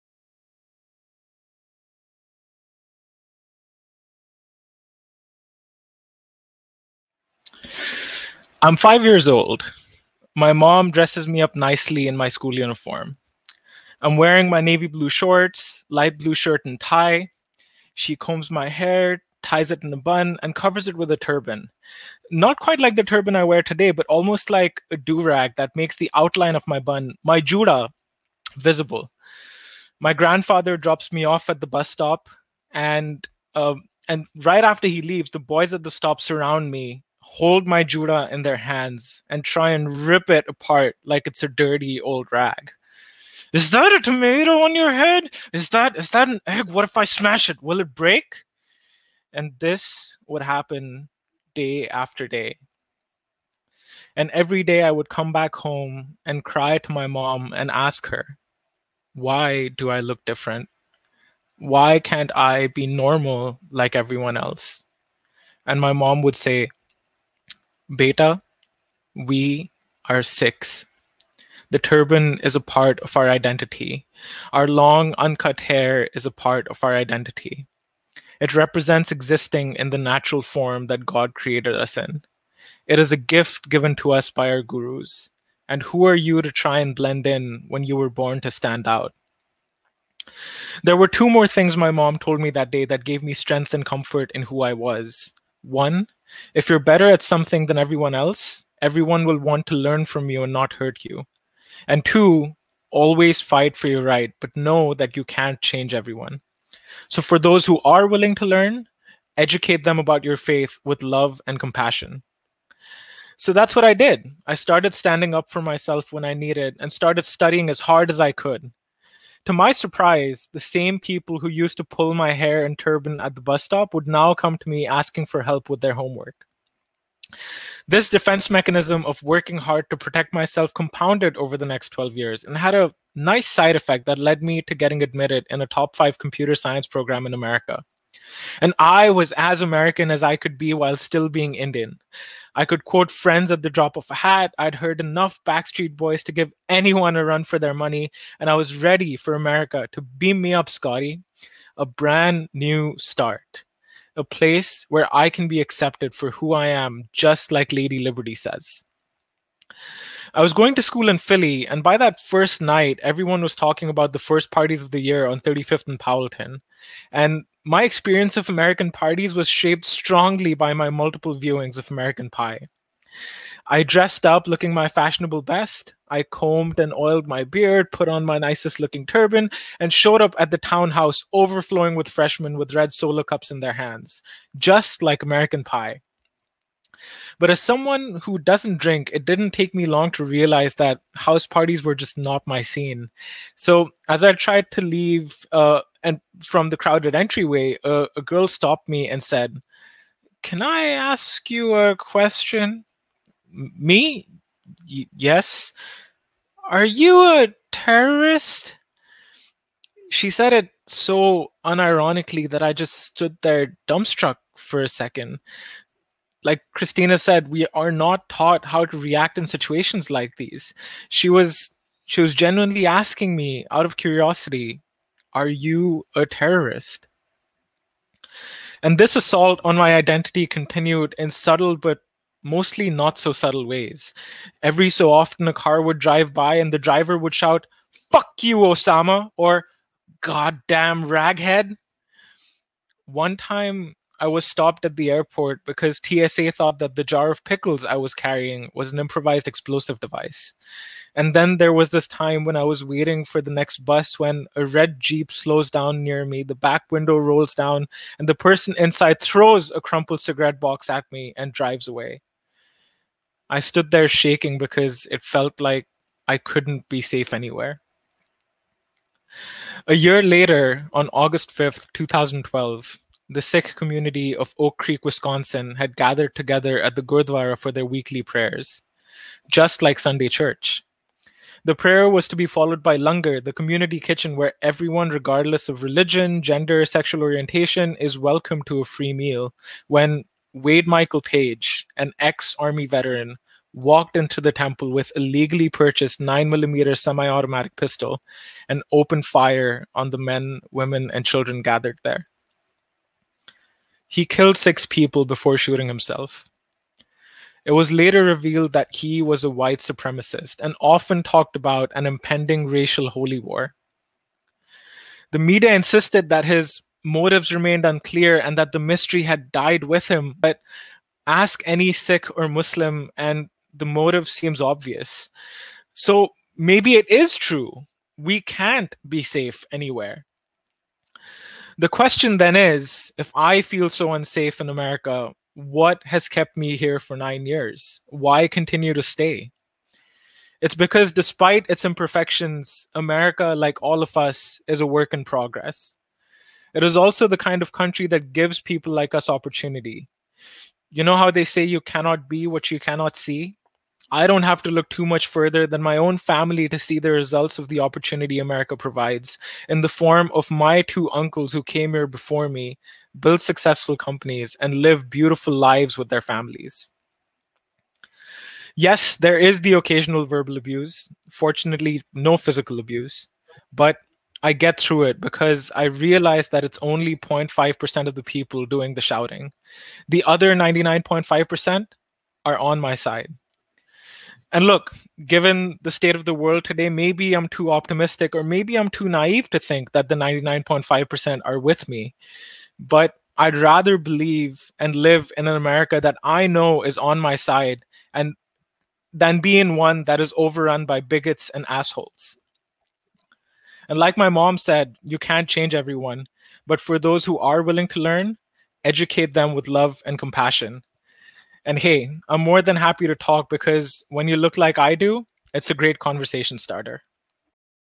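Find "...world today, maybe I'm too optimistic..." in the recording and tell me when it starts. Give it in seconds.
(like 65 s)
386 s.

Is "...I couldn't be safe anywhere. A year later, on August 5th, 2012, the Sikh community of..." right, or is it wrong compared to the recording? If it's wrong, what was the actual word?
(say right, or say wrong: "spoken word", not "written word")
right.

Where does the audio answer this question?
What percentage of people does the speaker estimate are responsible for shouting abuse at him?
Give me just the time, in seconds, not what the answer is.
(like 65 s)
377 s.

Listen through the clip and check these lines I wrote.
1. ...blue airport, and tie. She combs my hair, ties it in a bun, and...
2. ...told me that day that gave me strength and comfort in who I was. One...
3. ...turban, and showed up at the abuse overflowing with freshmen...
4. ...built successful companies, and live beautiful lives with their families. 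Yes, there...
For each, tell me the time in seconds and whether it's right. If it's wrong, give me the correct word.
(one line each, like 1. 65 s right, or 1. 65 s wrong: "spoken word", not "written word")
1. 16 s wrong: "shirt", not "airport"
2. 92 s right
3. 179 s wrong: "townhouse", not "abuse"
4. 363 s right.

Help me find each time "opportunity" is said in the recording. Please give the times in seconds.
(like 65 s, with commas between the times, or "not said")
349 s, 357 s.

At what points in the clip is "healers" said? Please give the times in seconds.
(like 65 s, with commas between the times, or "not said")
not said.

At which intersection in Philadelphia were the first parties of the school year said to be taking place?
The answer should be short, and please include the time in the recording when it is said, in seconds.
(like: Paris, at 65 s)
35th and Powelton, at 165 s.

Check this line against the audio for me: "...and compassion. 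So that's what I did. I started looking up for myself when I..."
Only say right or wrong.
wrong.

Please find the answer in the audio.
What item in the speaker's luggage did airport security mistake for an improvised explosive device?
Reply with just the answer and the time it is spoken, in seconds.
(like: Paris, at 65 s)
jar of pickles, at 247 s.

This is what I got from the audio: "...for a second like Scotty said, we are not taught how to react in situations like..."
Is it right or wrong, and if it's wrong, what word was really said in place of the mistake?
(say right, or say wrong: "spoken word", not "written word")
wrong: "Christina", not "Scotty".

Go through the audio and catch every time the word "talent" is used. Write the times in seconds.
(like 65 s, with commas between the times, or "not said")
not said.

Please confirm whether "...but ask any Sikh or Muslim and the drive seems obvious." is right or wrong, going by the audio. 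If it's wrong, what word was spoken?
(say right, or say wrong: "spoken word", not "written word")
wrong: "motive", not "drive".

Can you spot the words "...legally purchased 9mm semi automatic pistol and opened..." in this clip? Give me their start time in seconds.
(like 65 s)
295 s.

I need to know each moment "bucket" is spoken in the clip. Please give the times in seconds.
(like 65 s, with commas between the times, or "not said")
not said.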